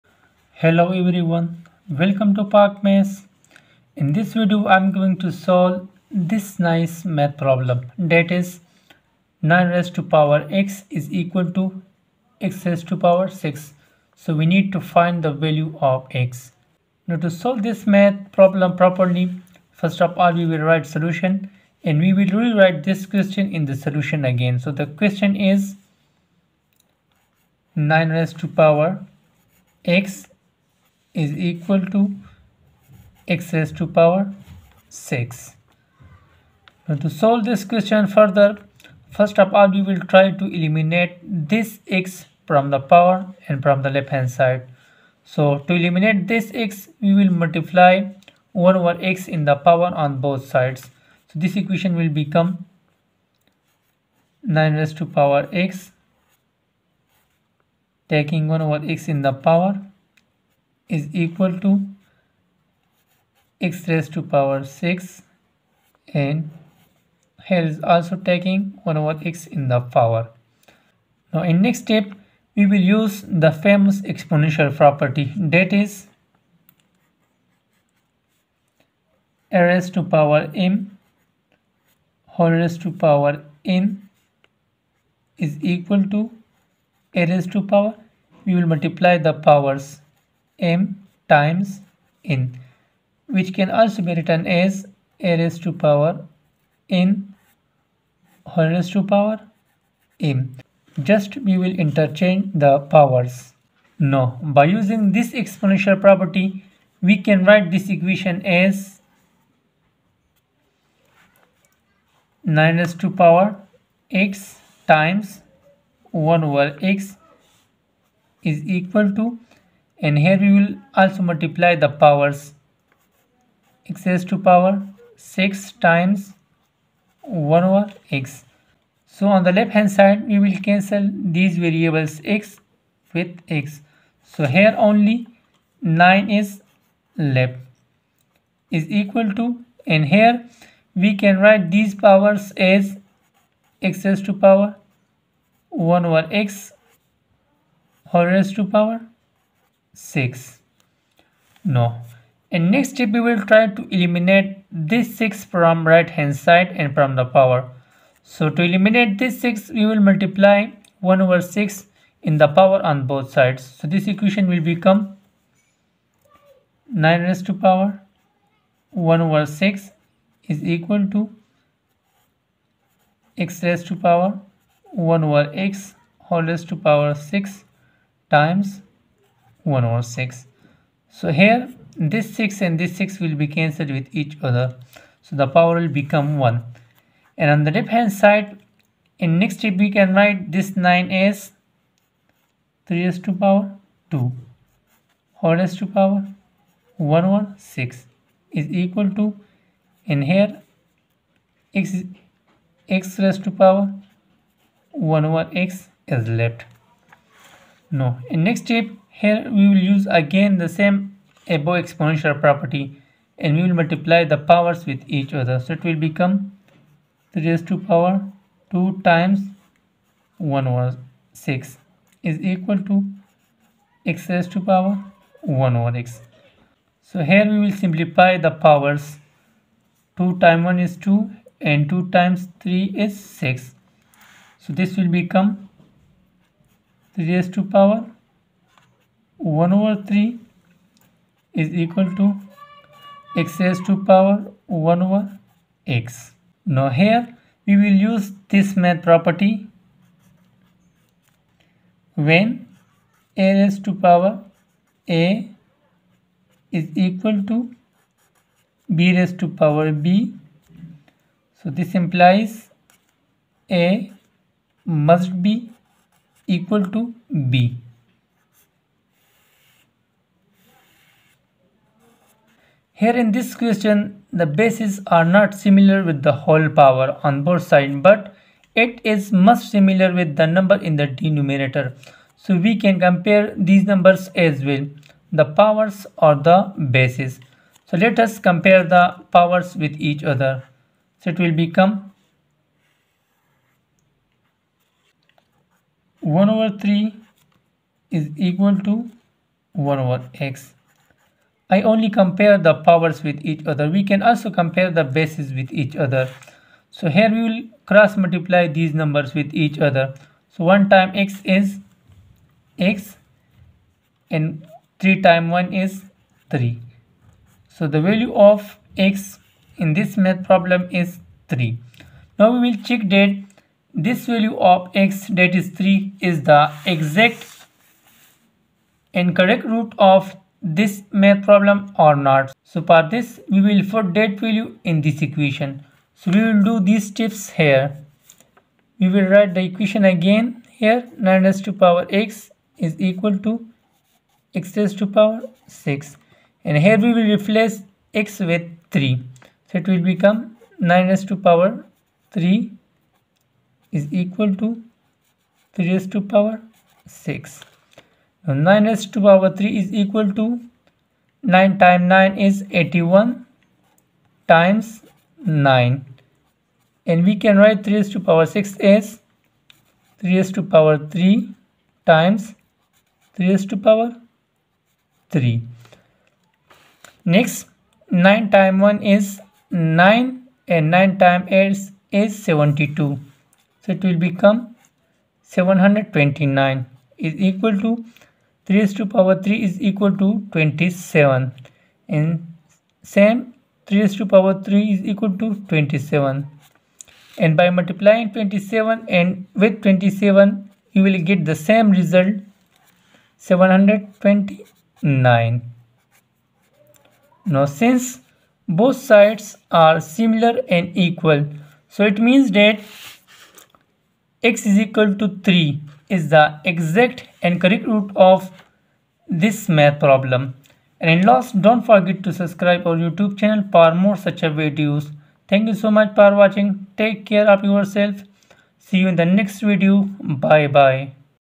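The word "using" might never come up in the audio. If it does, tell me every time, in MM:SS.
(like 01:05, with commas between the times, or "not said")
01:44.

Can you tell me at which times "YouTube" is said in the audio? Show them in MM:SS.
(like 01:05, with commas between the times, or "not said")
07:02.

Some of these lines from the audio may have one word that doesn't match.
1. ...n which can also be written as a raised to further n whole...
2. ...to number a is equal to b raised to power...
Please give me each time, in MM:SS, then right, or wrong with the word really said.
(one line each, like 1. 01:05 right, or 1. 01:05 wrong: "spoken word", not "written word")
1. 01:32 wrong: "power", not "further"
2. 04:13 wrong: "power", not "number".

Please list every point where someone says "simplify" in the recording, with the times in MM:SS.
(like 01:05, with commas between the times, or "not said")
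03:47.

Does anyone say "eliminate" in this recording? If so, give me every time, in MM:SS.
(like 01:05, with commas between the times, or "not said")
00:40, 00:45, 02:33, 02:38.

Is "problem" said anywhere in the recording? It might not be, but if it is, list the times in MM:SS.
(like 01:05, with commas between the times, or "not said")
00:07, 00:18, 05:20, 05:31, 06:59.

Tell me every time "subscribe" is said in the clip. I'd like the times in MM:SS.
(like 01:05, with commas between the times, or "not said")
07:02.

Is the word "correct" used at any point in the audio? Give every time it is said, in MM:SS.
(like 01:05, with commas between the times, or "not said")
05:29, 06:57.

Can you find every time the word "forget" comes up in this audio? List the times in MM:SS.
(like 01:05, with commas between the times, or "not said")
07:01.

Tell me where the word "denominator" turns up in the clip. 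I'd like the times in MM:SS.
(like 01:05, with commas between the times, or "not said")
04:41.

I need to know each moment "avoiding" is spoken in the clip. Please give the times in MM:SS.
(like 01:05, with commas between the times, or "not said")
not said.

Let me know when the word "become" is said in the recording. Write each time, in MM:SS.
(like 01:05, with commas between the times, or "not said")
00:52, 02:44, 03:06, 03:36, 03:55, 04:51, 05:50, 06:24.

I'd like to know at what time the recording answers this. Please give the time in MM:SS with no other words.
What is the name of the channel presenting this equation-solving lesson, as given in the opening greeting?
00:02.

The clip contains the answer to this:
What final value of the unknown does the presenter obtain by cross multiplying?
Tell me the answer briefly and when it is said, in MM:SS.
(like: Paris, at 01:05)
3, at 05:17.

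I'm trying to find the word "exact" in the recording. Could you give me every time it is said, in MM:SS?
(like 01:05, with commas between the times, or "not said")
05:26, 06:56.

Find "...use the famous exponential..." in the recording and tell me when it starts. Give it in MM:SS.
01:12.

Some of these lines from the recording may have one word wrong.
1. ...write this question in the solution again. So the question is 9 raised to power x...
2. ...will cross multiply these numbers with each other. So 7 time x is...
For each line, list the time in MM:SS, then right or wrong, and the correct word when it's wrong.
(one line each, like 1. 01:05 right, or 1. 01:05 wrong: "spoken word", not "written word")
1. 00:22 wrong: "rewrite", not "write"
2. 05:07 wrong: "1", not "7".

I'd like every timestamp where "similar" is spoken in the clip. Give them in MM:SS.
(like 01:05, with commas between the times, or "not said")
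04:35, 04:39, 06:50.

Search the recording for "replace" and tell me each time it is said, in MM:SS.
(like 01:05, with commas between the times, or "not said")
05:47.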